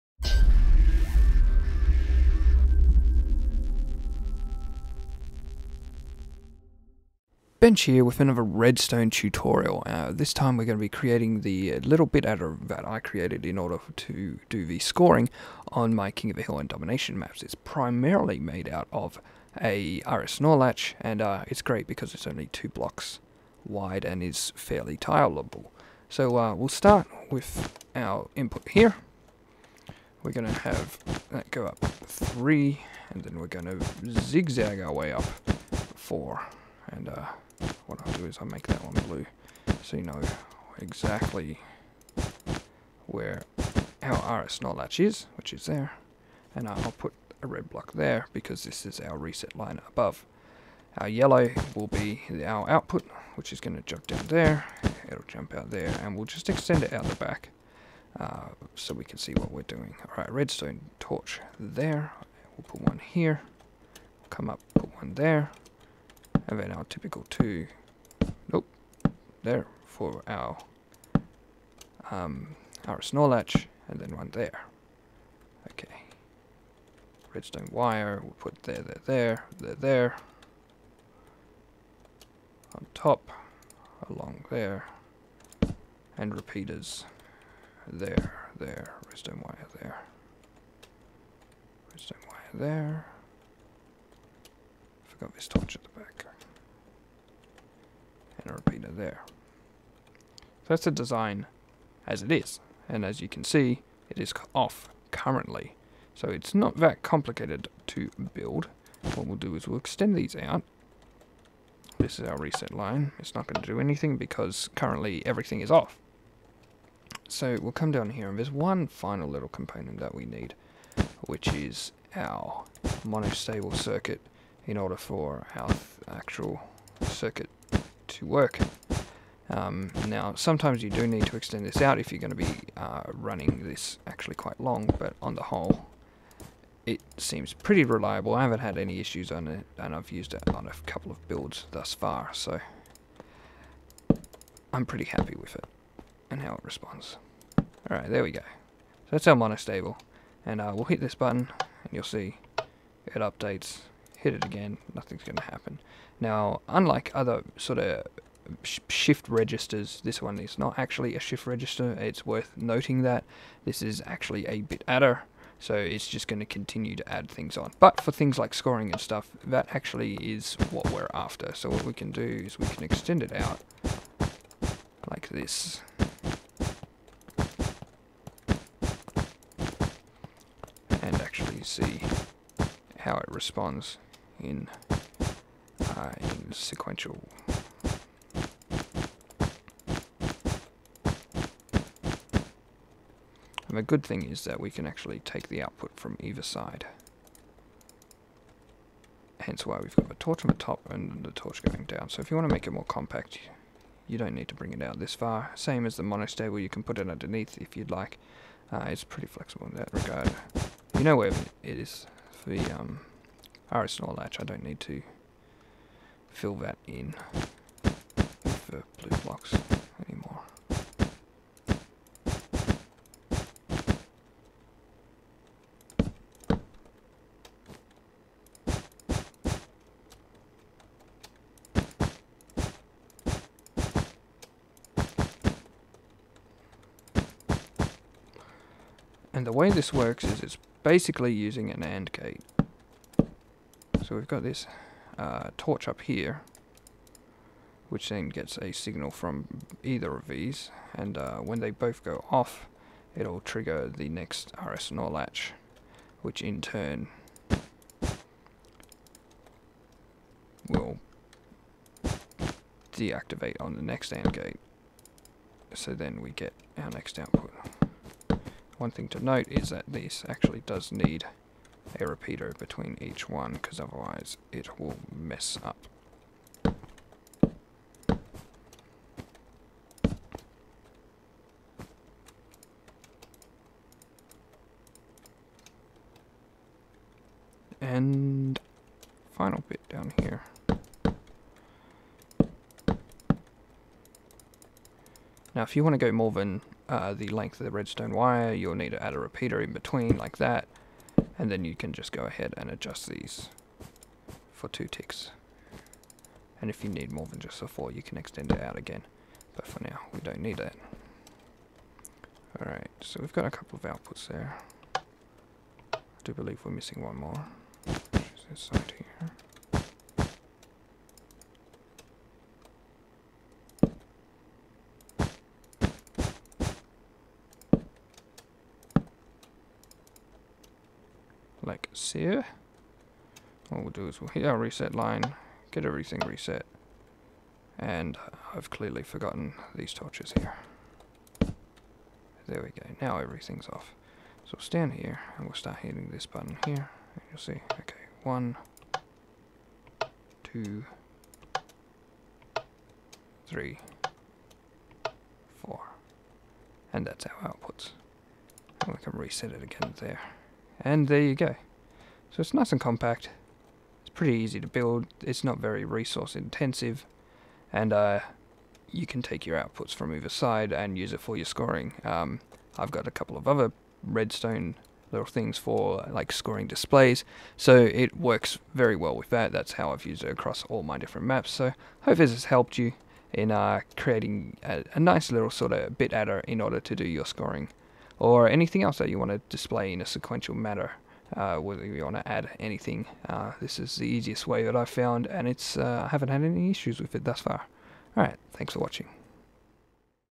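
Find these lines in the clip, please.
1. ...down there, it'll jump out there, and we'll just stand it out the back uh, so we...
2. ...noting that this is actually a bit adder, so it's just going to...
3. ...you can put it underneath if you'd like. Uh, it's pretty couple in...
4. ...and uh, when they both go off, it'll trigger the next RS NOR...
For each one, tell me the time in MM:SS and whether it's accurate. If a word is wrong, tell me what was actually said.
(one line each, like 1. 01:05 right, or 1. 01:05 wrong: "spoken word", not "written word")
1. 00:54 wrong: "extend", not "stand"
2. 02:42 right
3. 03:26 wrong: "flexible", not "couple"
4. 04:10 right.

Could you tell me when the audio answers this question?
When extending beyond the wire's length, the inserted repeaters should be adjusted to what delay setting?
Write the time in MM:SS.
05:04.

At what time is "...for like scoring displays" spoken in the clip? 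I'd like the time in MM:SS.
06:15.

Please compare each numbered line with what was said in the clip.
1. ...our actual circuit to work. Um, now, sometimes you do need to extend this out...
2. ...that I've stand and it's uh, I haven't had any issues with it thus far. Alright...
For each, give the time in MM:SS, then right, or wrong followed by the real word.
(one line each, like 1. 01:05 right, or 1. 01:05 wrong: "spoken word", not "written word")
1. 02:05 right
2. 06:34 wrong: "found", not "stand".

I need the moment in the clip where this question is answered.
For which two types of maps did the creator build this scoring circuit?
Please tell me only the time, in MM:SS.
00:16.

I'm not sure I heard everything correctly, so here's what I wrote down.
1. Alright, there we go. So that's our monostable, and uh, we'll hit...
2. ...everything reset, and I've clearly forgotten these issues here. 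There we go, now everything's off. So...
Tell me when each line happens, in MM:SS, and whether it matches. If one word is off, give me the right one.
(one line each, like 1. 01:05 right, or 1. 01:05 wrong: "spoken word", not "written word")
1. 02:27 right
2. 05:35 wrong: "torches", not "issues".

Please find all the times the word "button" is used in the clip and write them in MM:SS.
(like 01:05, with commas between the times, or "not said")
02:31, 05:46.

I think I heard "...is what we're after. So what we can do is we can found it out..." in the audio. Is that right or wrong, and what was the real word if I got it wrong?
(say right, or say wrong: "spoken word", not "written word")
wrong: "extend", not "found".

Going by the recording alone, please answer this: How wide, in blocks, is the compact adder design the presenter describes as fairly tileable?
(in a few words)
2 blocks.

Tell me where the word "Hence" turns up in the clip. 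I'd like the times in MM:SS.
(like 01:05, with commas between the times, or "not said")
03:19.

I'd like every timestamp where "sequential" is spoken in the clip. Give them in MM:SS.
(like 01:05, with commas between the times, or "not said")
03:06, 06:30.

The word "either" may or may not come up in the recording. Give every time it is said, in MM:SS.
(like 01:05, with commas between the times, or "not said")
03:16, 04:09, 06:10.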